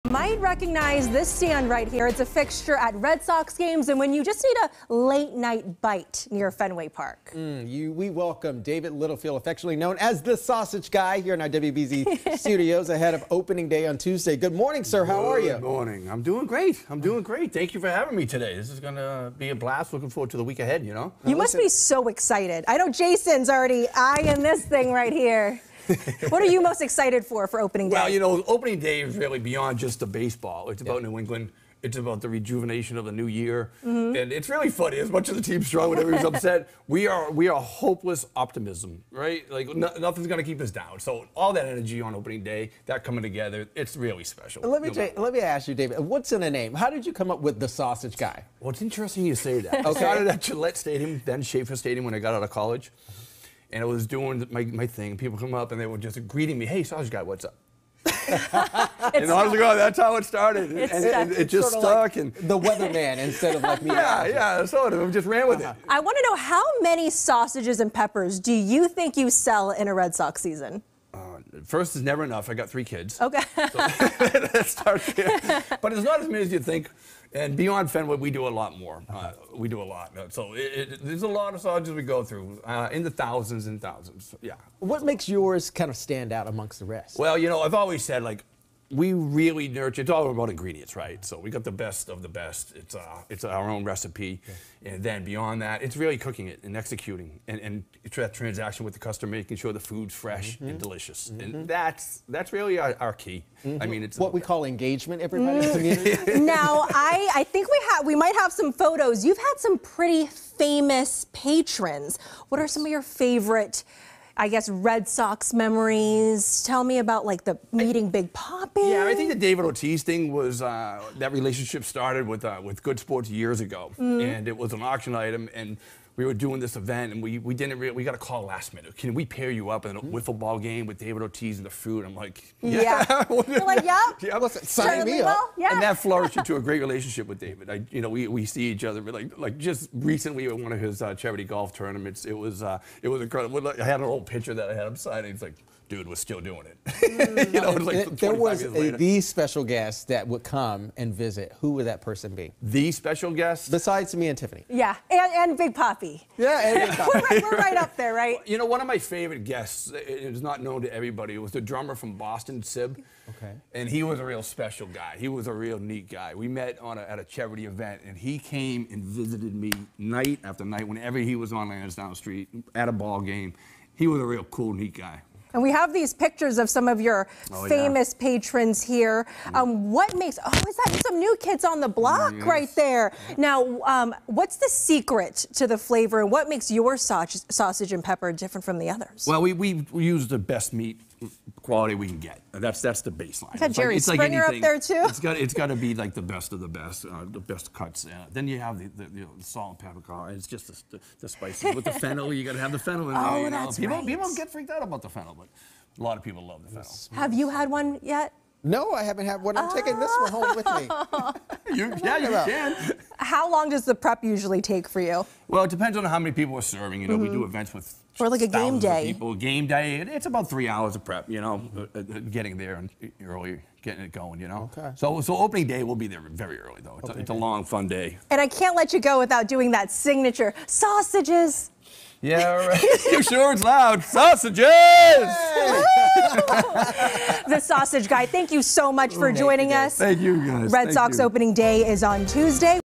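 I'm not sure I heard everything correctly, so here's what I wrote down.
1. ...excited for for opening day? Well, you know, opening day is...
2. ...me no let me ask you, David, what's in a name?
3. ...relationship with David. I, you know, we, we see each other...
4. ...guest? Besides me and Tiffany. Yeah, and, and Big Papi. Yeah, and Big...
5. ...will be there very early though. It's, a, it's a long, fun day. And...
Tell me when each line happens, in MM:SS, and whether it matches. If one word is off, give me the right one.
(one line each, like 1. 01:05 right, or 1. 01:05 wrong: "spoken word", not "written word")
1. 00:26 right
2. 00:44 right
3. 02:16 right
4. 02:33 right
5. 03:45 right.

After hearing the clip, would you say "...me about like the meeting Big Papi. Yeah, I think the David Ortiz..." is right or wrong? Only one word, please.
right.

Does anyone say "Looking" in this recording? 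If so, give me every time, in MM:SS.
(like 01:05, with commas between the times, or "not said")
00:19.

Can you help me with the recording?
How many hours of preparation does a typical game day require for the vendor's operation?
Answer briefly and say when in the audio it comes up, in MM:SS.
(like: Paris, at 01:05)
3 hours, at 03:40.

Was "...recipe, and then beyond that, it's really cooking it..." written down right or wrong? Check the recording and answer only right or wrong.
right.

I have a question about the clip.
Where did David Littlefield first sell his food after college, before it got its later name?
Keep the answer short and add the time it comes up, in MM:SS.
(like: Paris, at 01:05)
Schaefer Stadium, at 00:51.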